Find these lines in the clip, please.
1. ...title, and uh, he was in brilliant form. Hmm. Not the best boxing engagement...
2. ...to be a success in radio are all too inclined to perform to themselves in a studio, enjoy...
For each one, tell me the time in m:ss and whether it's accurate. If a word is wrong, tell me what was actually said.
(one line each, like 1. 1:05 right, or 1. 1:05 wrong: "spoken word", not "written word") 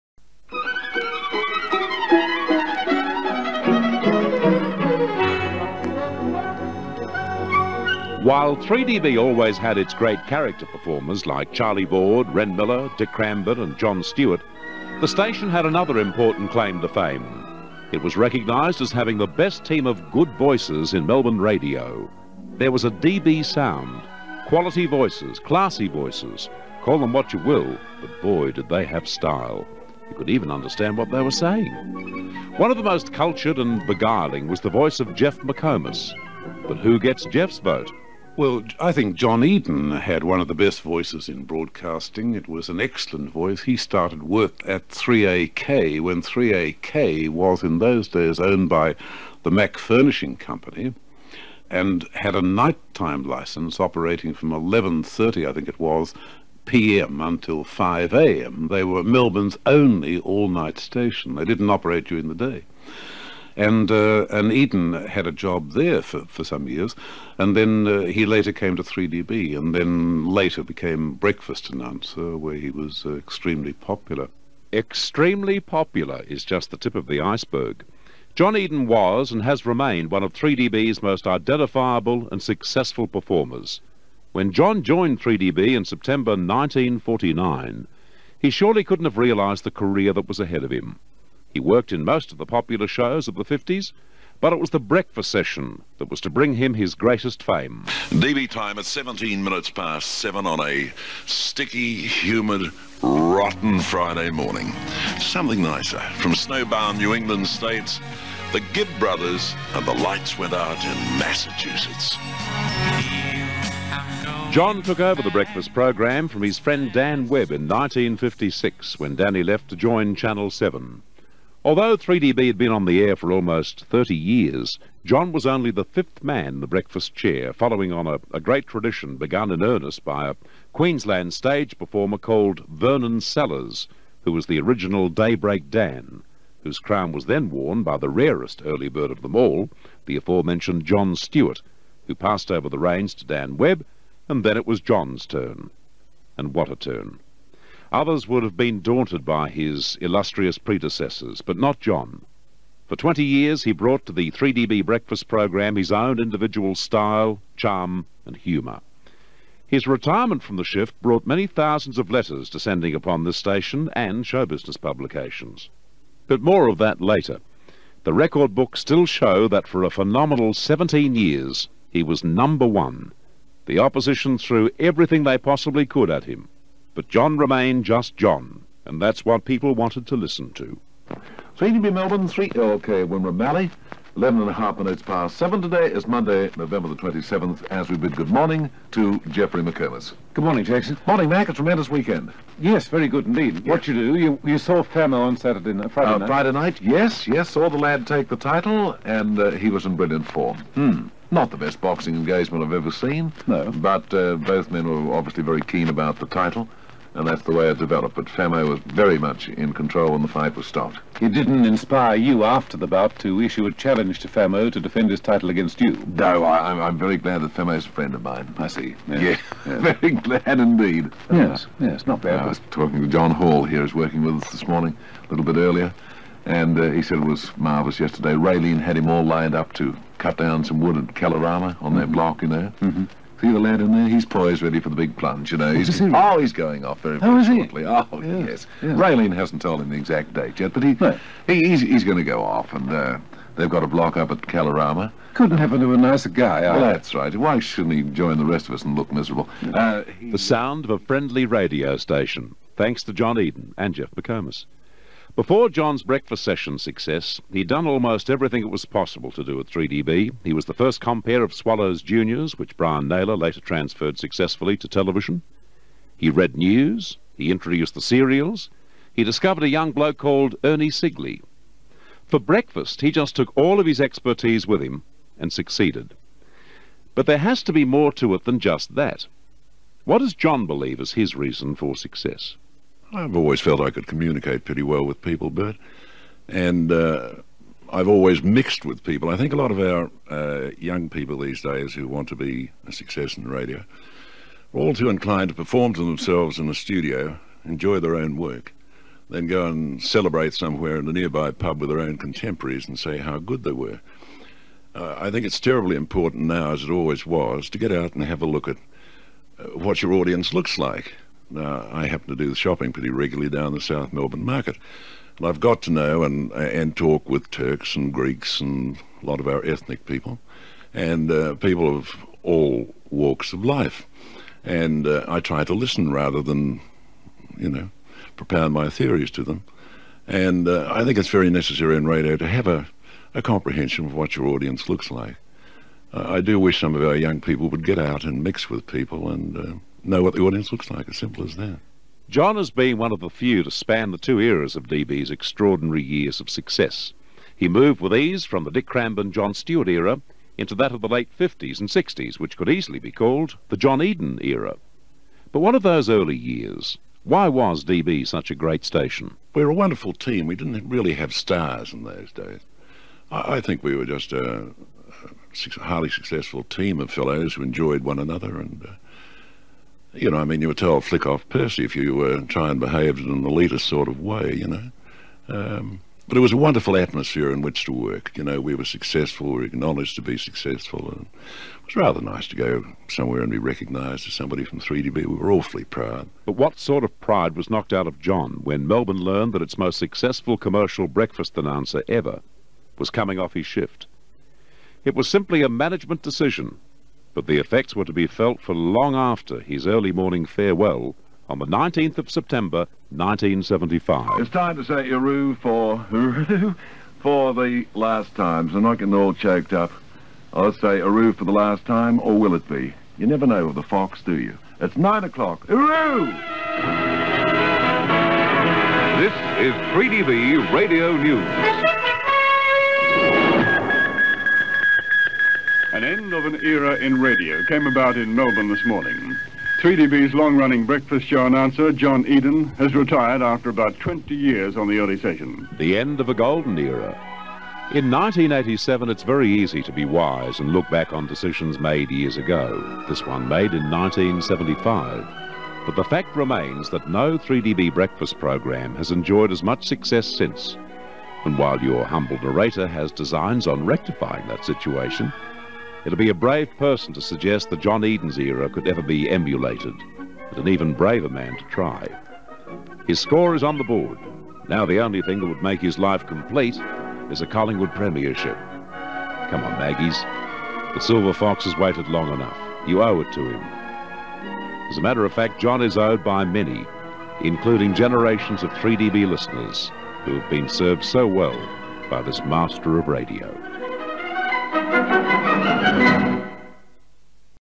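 1. 3:18 right
2. 4:52 right.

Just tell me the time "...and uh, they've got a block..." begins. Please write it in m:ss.
4:02.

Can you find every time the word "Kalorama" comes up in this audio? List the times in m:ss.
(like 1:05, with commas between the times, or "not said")
3:51, 4:04.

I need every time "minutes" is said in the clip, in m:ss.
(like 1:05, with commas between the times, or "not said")
1:39, 3:04.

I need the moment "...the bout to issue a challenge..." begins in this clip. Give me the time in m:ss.
3:32.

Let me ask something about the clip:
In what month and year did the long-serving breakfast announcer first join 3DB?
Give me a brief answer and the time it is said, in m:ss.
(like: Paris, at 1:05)
September 1949, at 1:25.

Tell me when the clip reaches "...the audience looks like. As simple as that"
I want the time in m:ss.
5:40.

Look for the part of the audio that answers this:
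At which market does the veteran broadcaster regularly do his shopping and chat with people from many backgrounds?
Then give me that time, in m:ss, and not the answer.
5:13.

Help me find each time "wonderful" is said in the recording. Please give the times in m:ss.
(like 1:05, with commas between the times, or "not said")
5:59, 6:16.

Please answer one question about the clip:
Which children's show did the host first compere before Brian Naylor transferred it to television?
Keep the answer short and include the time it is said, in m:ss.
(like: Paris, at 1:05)
Swallows Juniors, at 4:21.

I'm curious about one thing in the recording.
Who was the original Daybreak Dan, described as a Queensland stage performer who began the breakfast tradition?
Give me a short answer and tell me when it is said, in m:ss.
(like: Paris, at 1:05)
Vernon Sellers, at 2:12.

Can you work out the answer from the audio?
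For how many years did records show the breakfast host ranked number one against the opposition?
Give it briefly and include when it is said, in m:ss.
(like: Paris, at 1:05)
17, at 2:50.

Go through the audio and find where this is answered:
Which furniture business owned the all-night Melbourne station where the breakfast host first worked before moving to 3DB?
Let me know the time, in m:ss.
0:49.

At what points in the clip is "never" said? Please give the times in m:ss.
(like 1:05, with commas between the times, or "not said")
6:53.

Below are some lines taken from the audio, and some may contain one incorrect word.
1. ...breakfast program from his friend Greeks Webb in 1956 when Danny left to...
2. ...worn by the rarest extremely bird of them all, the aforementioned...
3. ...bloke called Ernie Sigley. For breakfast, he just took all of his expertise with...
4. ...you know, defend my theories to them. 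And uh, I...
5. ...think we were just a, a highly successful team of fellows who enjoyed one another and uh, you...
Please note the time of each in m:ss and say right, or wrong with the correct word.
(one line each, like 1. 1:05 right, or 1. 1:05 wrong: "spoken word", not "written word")
1. 1:55 wrong: "Dan", not "Greeks"
2. 2:17 wrong: "early", not "extremely"
3. 4:29 right
4. 5:27 wrong: "propound", not "defend"
5. 6:03 right.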